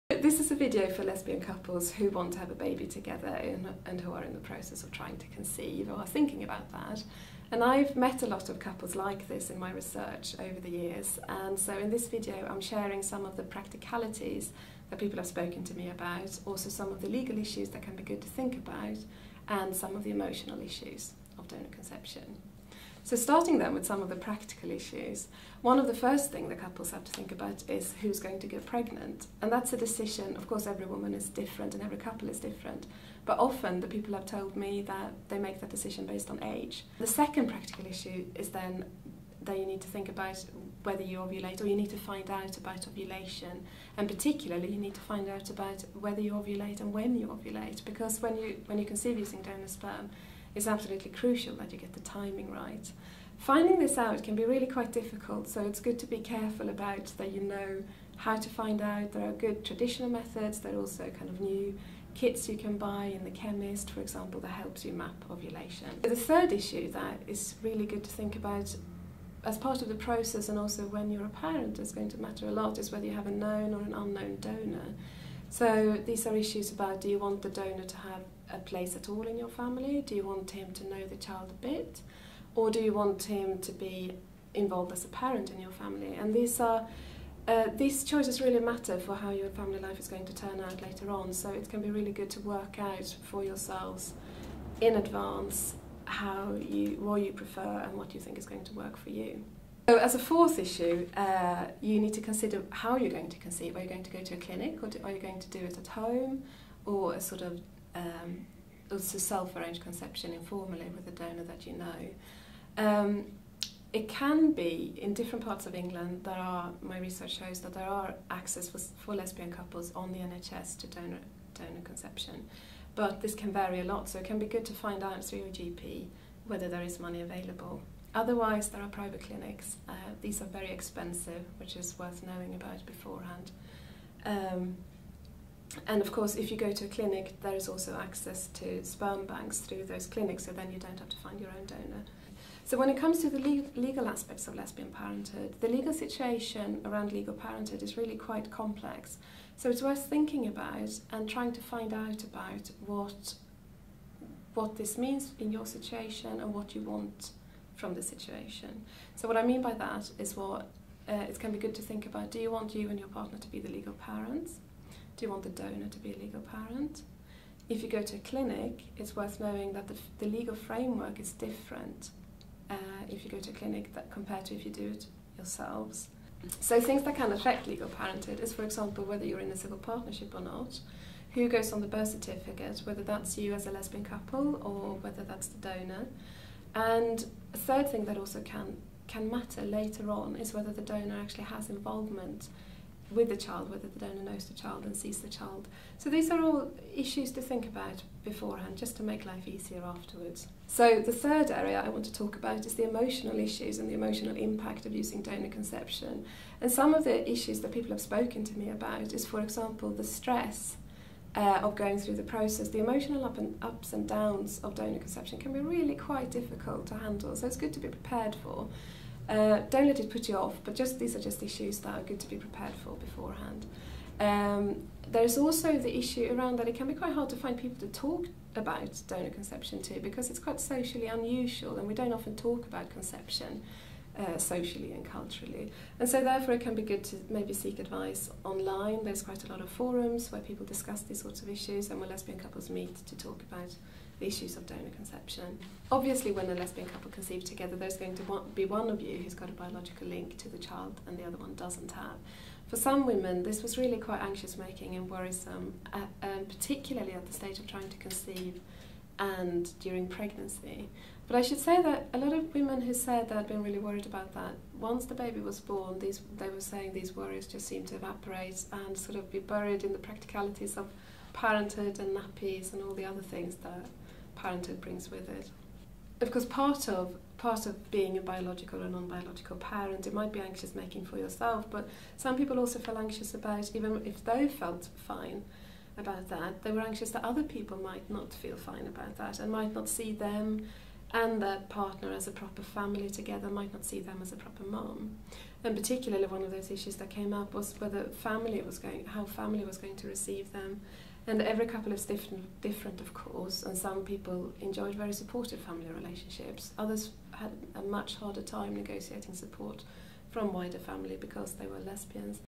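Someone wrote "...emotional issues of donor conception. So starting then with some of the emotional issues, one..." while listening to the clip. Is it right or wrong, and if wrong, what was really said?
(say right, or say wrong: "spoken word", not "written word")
wrong: "practical", not "emotional".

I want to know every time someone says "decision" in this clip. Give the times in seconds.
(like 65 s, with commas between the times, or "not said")
29 s, 35 s.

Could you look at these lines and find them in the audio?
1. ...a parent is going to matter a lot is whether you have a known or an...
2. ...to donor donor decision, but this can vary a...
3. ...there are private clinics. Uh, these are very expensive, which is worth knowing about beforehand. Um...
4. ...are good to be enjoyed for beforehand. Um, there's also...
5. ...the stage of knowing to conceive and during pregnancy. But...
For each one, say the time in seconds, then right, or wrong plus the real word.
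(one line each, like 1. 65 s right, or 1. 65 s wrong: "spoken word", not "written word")
1. 71 s right
2. 120 s wrong: "conception", not "decision"
3. 128 s right
4. 221 s wrong: "prepared", not "enjoyed"
5. 257 s wrong: "trying", not "knowing".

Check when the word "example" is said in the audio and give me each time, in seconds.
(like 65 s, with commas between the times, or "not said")
64 s, 178 s, 209 s.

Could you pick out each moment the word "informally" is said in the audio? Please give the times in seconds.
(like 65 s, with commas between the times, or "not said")
110 s.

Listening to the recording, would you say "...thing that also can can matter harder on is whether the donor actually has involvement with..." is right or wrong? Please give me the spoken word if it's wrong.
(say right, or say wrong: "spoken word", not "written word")
wrong: "later", not "harder".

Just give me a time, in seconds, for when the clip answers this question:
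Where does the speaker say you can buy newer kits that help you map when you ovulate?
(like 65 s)
63 s.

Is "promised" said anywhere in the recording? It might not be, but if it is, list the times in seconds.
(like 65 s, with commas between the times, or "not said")
not said.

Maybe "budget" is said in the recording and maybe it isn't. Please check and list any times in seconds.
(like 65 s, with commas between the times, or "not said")
not said.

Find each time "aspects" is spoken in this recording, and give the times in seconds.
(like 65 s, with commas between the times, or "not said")
144 s.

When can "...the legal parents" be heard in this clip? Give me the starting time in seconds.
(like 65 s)
163 s.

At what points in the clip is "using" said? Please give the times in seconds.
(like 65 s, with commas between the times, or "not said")
49 s, 204 s.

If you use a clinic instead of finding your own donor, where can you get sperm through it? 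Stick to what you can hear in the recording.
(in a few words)
Sperm banks.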